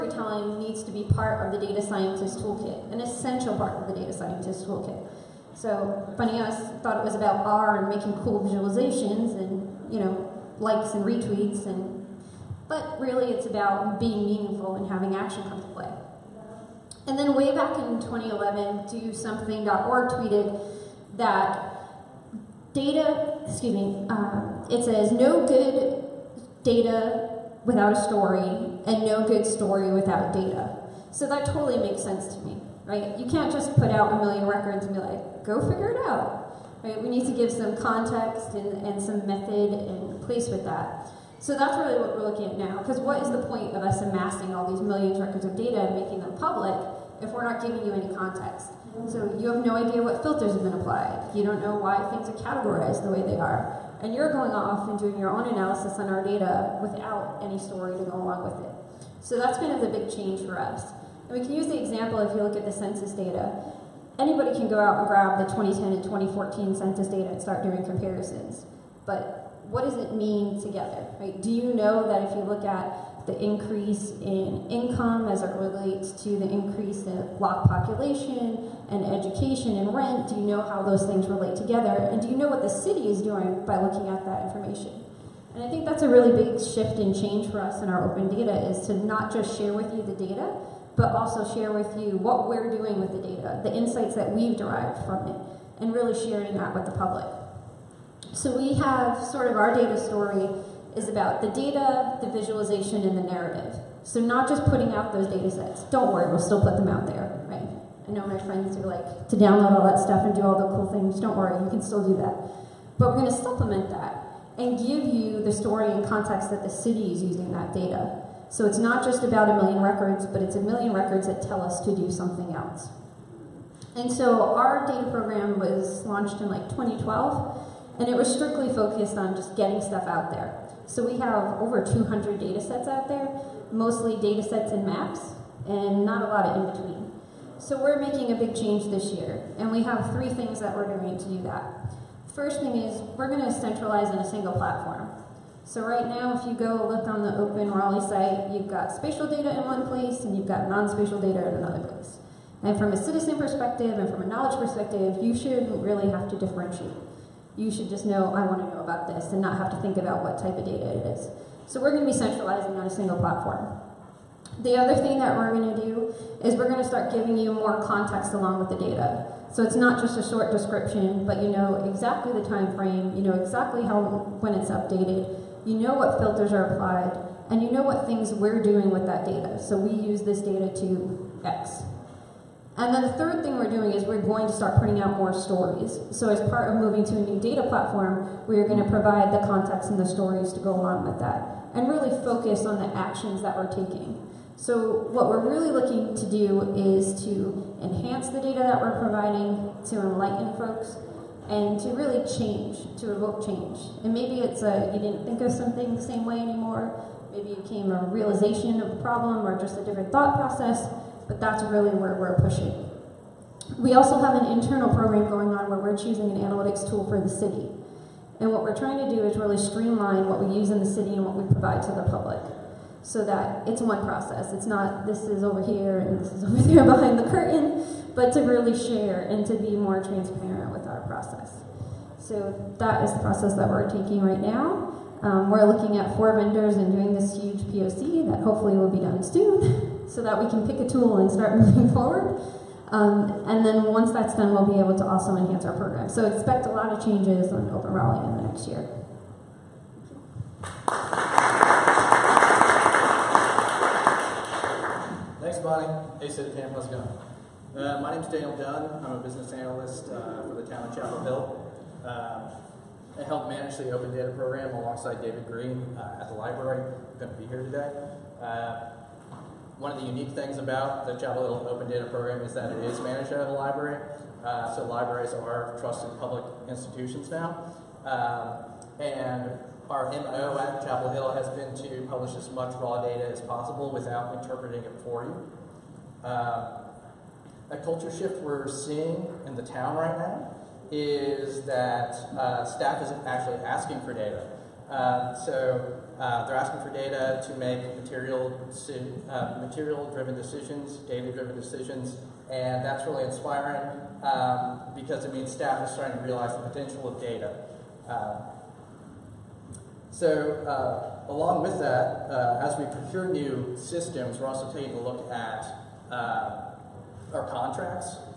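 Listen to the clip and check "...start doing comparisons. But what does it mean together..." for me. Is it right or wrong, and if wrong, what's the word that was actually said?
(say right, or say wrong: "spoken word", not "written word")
right.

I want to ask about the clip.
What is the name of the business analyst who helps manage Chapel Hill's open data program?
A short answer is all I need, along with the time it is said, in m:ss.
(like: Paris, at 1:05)
Daniel Dunn, at 4:18.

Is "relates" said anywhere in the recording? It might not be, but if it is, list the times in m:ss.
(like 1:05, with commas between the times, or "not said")
1:15, 1:21.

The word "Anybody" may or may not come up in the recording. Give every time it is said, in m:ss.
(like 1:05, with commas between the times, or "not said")
1:04.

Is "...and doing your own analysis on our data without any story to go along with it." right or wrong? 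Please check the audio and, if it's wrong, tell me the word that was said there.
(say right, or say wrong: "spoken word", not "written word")
right.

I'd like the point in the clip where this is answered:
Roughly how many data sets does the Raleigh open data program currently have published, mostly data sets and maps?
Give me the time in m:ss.
2:11.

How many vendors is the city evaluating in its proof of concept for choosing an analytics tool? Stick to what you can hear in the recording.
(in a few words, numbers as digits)
4.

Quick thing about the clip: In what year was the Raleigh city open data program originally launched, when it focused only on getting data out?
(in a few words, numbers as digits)
2012.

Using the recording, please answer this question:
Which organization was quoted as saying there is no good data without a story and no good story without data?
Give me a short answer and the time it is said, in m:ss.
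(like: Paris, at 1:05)
DoSomething.org, at 0:18.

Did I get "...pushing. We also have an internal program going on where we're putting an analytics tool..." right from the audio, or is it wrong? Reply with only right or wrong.
wrong.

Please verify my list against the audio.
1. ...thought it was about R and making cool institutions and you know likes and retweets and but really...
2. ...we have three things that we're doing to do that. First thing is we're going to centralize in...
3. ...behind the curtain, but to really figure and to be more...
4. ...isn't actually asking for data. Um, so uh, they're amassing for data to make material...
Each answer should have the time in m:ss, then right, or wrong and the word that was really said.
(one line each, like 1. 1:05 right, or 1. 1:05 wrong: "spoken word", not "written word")
1. 0:06 wrong: "visualizations", not "institutions"
2. 2:19 right
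3. 3:46 wrong: "share", not "figure"
4. 4:53 wrong: "asking", not "amassing".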